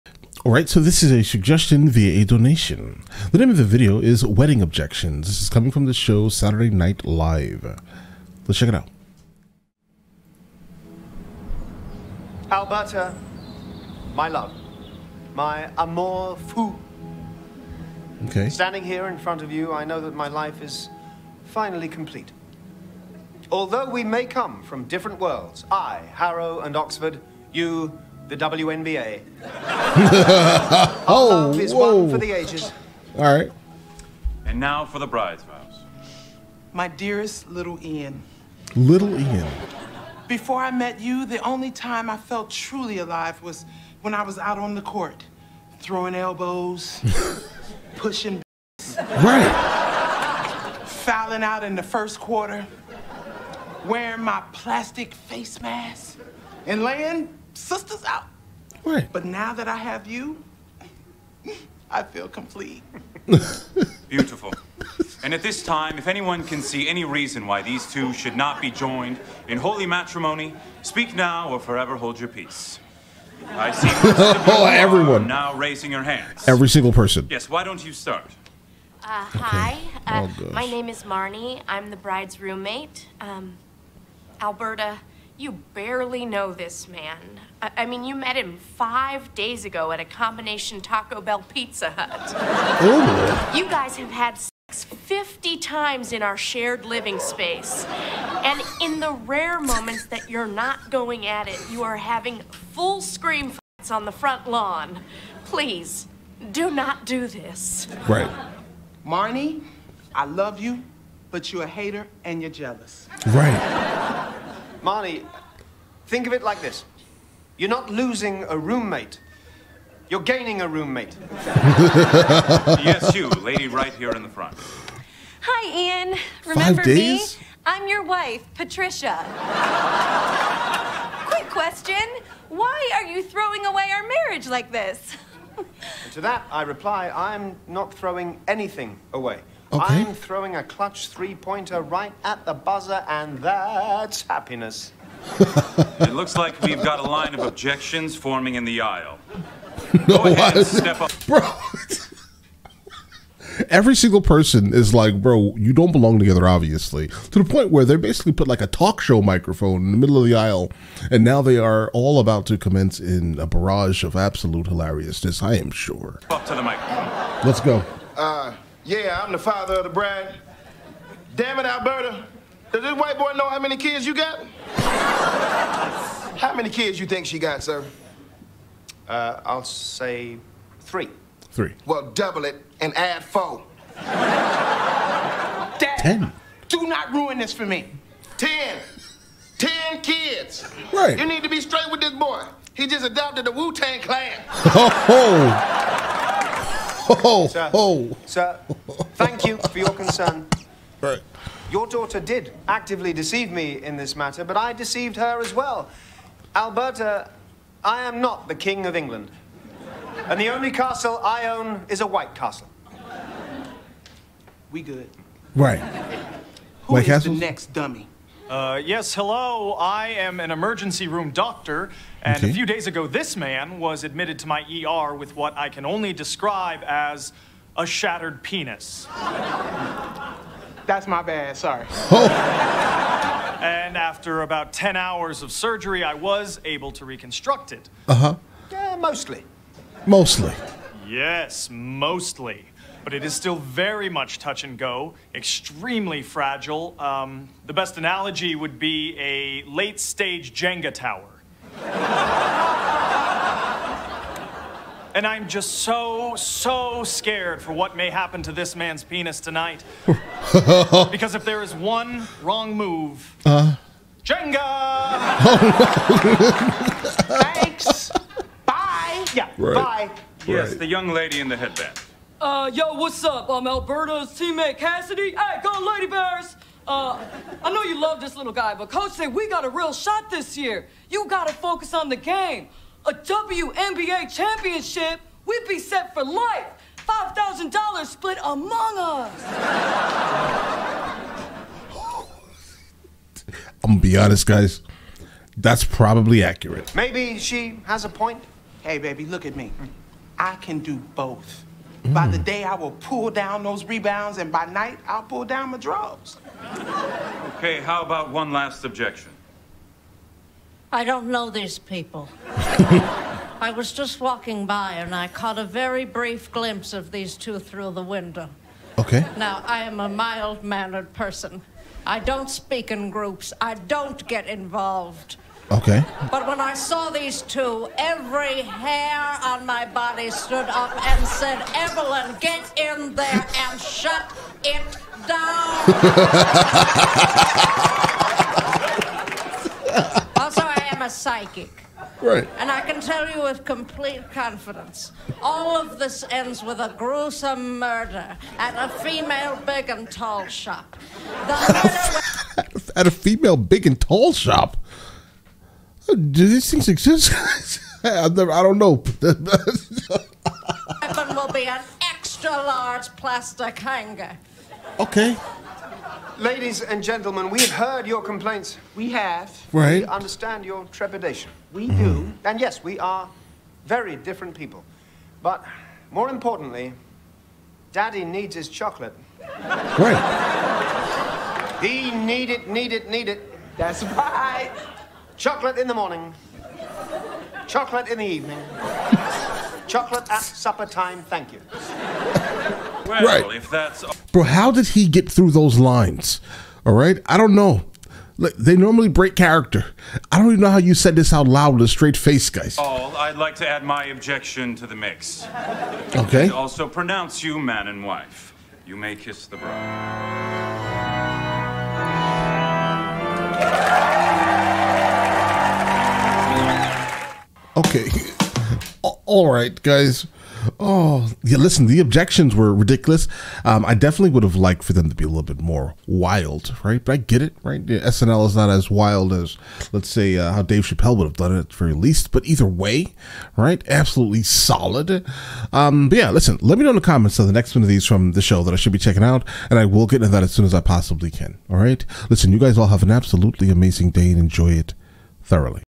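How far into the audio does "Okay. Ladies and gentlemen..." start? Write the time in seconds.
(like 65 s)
364 s.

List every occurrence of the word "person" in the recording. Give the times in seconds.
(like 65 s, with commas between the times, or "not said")
76 s, 154 s, 321 s.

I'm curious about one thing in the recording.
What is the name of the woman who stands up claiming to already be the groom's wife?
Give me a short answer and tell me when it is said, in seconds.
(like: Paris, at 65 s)
Patricia, at 128 s.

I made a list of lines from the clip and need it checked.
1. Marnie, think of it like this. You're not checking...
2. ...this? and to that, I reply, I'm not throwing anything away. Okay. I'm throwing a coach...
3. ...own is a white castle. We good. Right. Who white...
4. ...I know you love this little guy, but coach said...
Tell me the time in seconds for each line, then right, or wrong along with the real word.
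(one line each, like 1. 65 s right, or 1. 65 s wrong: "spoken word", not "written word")
1. 114 s wrong: "losing", not "checking"
2. 134 s wrong: "clutch", not "coach"
3. 211 s right
4. 277 s right.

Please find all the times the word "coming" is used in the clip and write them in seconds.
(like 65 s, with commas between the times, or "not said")
5 s.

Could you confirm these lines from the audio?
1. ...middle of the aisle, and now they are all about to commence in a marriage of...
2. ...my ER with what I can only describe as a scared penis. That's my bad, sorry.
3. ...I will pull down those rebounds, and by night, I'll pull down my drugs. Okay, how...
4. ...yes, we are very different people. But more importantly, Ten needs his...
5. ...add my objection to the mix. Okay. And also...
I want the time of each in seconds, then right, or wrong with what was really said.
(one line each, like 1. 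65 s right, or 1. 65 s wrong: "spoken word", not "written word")
1. 159 s wrong: "barrage", not "marriage"
2. 224 s wrong: "shattered", not "scared"
3. 302 s right
4. 372 s wrong: "Daddy", not "Ten"
5. 403 s right.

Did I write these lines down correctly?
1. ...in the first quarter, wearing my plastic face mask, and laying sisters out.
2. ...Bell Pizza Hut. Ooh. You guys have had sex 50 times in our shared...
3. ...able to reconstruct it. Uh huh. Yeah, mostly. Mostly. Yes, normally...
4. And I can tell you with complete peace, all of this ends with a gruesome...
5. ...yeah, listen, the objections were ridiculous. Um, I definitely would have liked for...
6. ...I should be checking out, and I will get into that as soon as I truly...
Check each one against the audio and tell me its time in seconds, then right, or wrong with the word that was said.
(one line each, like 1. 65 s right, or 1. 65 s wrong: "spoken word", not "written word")
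1. 51 s right
2. 91 s right
3. 236 s wrong: "mostly", not "normally"
4. 342 s wrong: "confidence", not "peace"
5. 421 s right
6. 438 s wrong: "possibly", not "truly".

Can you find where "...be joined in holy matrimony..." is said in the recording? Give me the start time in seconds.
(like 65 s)
68 s.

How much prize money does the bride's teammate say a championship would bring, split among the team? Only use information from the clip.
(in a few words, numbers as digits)
$5,000.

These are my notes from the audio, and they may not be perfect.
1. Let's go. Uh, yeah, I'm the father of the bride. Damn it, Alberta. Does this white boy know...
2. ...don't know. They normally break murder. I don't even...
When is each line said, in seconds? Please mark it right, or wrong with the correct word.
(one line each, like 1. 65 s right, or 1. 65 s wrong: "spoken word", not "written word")
1. 167 s right
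2. 397 s wrong: "character", not "murder".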